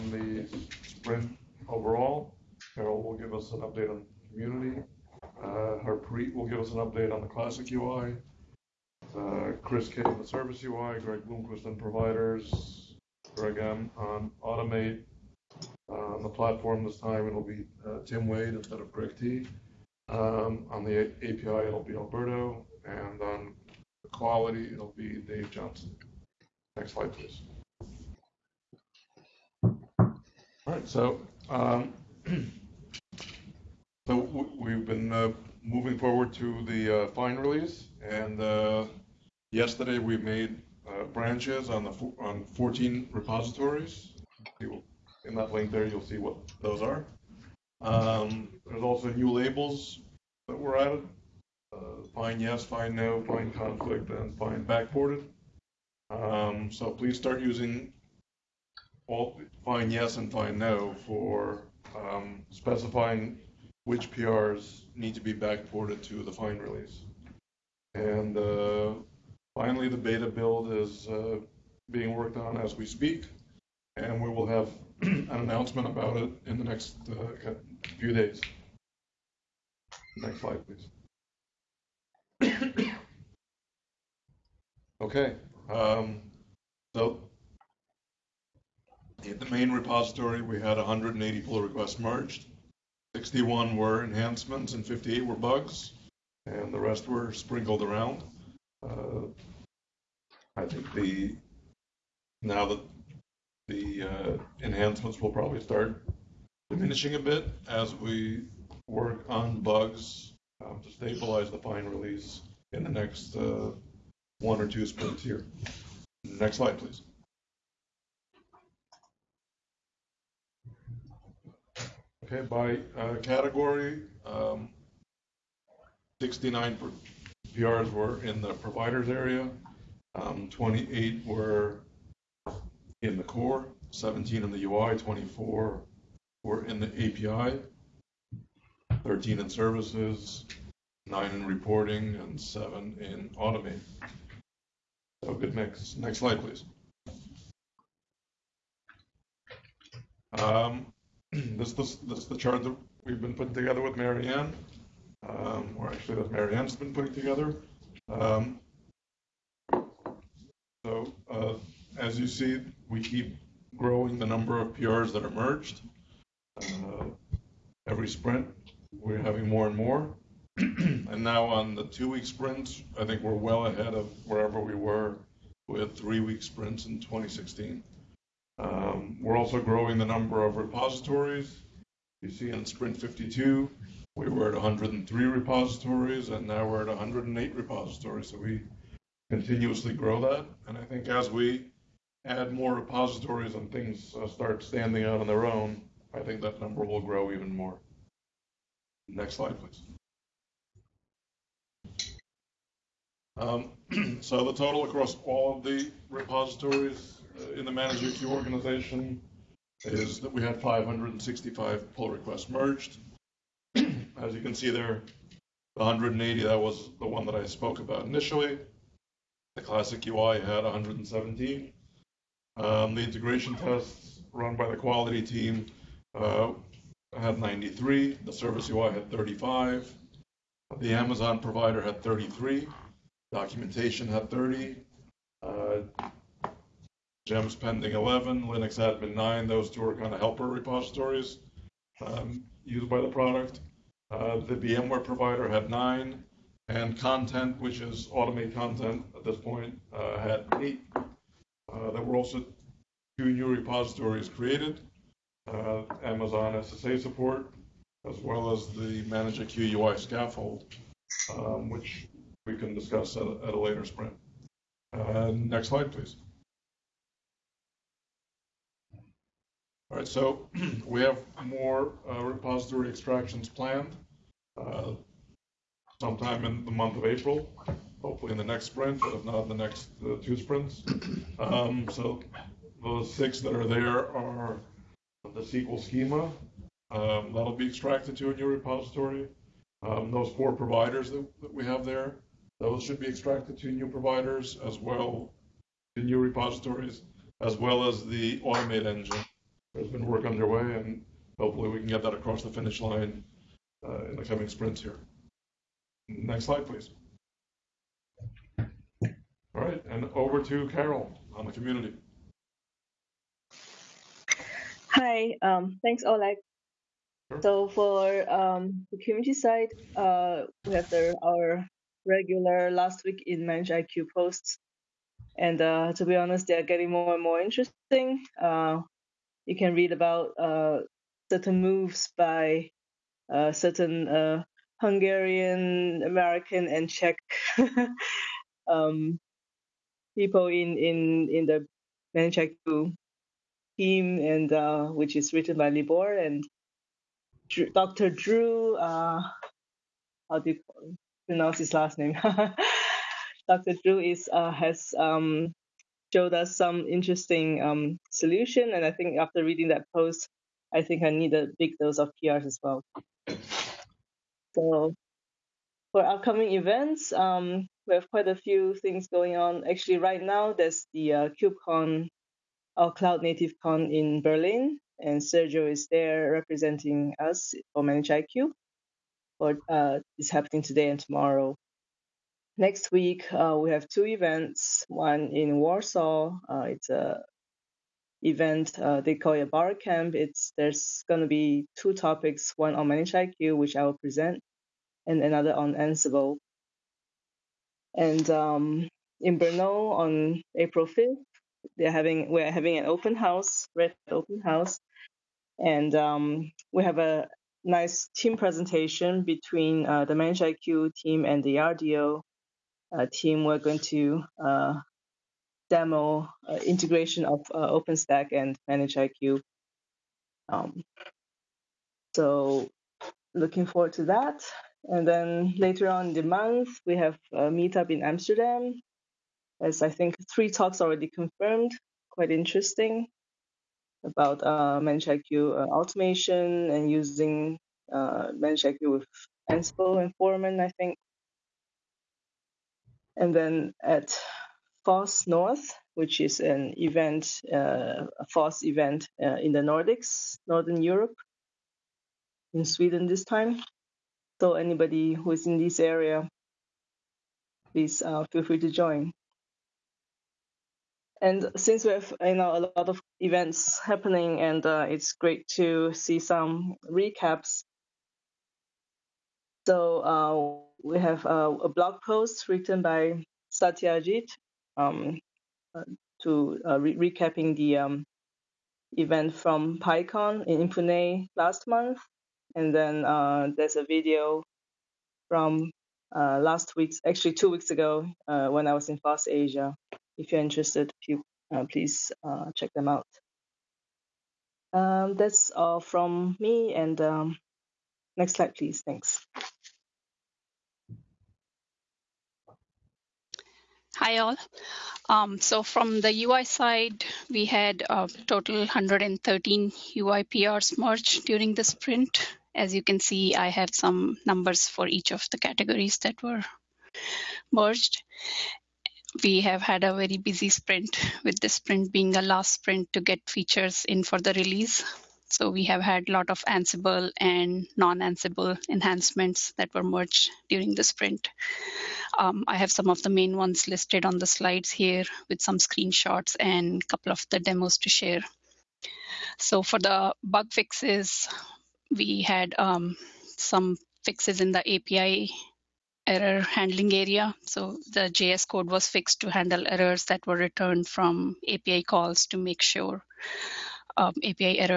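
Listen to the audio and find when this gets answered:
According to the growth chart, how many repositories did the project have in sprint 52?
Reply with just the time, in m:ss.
3:04.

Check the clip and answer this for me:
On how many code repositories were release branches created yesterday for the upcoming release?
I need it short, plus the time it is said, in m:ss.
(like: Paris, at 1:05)
14, at 0:42.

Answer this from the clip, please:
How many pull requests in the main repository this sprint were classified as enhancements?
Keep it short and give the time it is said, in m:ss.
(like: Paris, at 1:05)
61, at 1:33.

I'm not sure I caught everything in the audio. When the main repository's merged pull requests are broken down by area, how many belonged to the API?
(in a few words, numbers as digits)
24.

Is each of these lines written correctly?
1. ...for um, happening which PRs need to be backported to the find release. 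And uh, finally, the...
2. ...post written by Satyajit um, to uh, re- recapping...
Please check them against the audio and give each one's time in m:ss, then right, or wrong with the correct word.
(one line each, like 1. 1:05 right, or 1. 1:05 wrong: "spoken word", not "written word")
1. 1:01 wrong: "specifying", not "happening"
2. 7:52 right.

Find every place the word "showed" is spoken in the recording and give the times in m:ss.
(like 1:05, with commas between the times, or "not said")
5:56.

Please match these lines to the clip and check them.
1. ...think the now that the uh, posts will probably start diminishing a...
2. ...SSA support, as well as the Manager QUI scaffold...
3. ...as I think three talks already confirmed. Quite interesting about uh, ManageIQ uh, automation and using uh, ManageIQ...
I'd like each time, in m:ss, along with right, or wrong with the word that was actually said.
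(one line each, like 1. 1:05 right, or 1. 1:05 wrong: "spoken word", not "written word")
1. 1:40 wrong: "enhancements", not "posts"
2. 4:16 right
3. 7:09 right.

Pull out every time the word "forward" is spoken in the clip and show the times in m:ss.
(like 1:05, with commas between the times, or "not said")
0:35, 7:03.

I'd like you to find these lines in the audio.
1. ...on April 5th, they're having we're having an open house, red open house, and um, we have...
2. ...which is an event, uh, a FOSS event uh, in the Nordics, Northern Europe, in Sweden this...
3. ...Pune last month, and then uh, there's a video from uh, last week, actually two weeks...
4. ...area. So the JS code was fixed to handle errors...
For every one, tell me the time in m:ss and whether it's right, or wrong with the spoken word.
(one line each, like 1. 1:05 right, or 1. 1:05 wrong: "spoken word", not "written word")
1. 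6:39 right
2. 7:25 right
3. 8:00 right
4. 9:06 right.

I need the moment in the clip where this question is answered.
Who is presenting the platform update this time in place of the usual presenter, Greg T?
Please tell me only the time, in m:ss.
0:18.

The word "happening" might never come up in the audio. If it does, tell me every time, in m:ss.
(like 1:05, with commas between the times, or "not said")
6:20, 7:43.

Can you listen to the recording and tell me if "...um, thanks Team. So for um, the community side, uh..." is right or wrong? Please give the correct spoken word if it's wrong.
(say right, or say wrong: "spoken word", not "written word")
wrong: "Oleg", not "Team".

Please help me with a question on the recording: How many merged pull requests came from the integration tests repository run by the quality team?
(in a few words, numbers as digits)
93.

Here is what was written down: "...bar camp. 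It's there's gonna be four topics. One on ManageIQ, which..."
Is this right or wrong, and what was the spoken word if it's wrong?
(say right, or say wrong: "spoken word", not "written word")
wrong: "two", not "four".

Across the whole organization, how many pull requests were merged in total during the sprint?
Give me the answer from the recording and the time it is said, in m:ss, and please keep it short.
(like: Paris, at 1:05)
565, at 3:30.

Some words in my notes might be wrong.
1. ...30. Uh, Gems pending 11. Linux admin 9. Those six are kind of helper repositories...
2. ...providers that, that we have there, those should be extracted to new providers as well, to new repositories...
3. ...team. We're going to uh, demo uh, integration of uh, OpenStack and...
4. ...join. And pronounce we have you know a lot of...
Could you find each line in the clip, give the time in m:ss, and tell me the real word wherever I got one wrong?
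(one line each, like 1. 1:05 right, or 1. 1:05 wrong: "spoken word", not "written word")
1. 3:54 wrong: "two", not "six"
2. 4:50 right
3. 6:53 right
4. 7:38 wrong: "since", not "pronounce".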